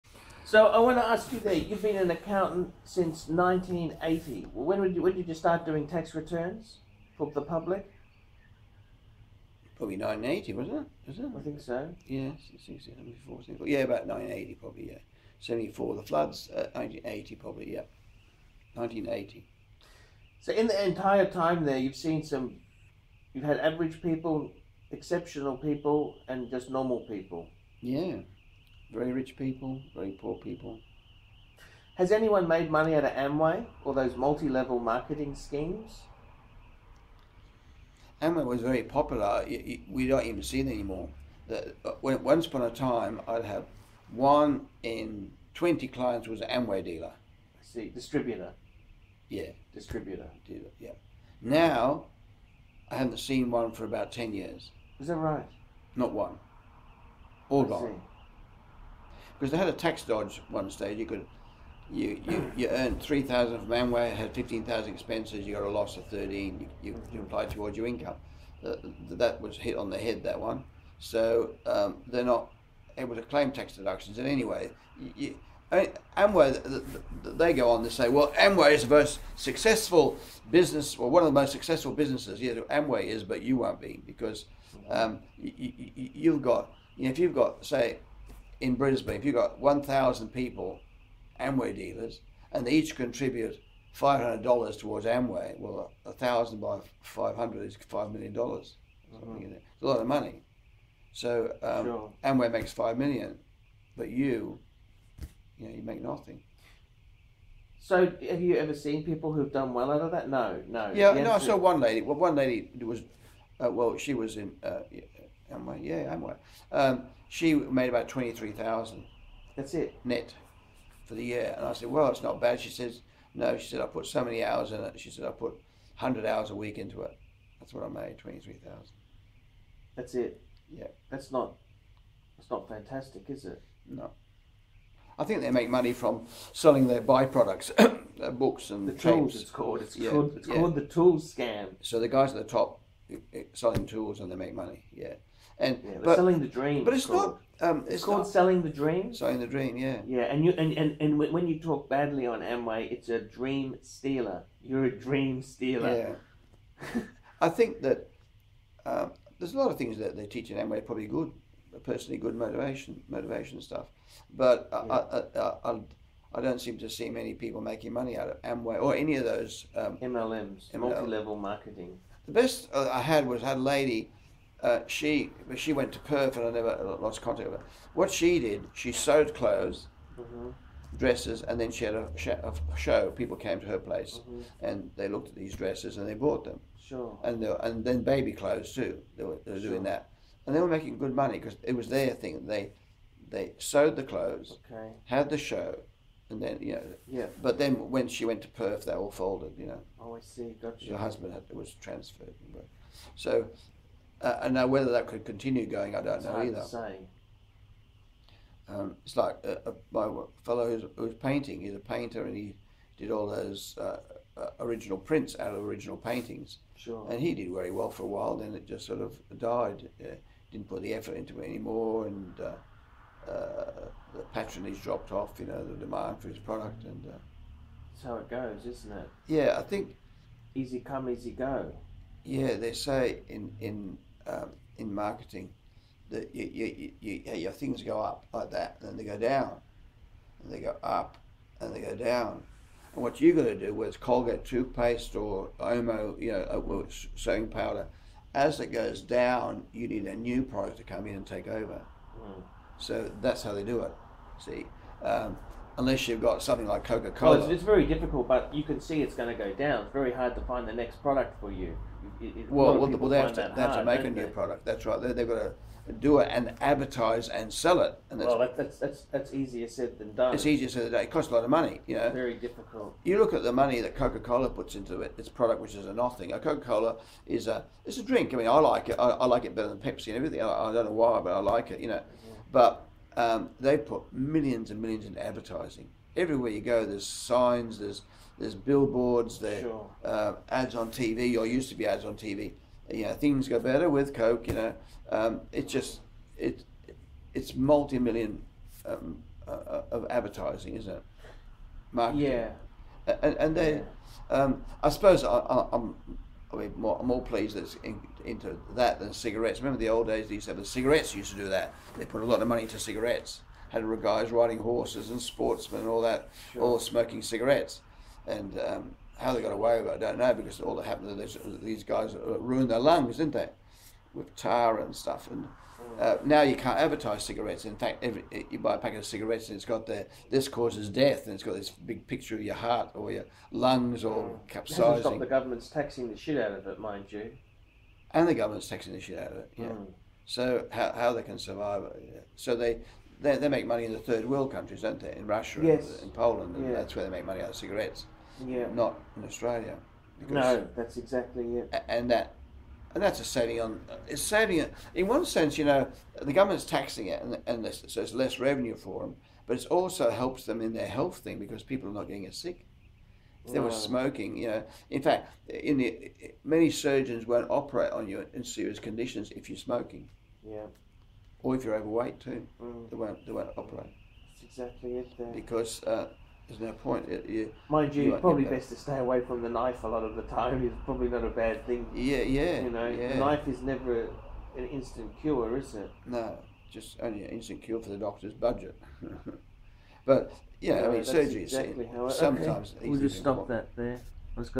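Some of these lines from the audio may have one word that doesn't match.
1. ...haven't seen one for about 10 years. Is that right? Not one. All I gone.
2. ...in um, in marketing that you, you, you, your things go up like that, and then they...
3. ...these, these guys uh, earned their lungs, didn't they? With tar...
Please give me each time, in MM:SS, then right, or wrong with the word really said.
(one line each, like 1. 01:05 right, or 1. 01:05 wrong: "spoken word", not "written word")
1. 00:52 right
2. 03:53 right
3. 05:21 wrong: "ruined", not "earned".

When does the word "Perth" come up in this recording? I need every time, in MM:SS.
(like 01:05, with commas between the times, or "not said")
02:55, 03:18.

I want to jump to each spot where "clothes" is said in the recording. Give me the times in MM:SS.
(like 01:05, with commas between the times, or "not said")
02:59, 03:08, 03:14.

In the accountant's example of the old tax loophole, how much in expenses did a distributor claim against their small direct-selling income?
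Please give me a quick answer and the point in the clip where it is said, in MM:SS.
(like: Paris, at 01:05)
15,000, at 01:04.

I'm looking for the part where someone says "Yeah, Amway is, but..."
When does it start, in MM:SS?
01:22.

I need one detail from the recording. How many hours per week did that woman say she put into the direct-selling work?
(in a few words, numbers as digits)
100.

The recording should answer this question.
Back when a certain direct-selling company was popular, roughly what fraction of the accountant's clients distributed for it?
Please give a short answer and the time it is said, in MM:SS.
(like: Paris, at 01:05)
1 in 20, at 00:44.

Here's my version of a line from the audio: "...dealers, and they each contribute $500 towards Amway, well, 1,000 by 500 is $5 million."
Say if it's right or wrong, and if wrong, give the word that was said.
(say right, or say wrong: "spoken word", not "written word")
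right.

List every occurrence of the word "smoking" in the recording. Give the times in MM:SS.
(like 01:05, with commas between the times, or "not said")
05:16, 06:03, 06:09.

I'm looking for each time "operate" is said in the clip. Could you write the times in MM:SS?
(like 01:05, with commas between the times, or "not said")
06:07, 06:13.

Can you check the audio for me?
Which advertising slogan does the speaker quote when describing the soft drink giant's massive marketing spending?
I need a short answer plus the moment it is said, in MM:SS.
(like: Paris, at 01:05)
Things go better with Coke, at 04:53.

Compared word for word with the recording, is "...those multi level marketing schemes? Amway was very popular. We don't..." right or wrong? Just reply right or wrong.
right.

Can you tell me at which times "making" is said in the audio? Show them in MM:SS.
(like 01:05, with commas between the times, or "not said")
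02:47, 03:10.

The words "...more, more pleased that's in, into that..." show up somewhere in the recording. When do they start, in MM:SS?
05:06.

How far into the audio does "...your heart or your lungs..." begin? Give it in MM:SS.
05:32.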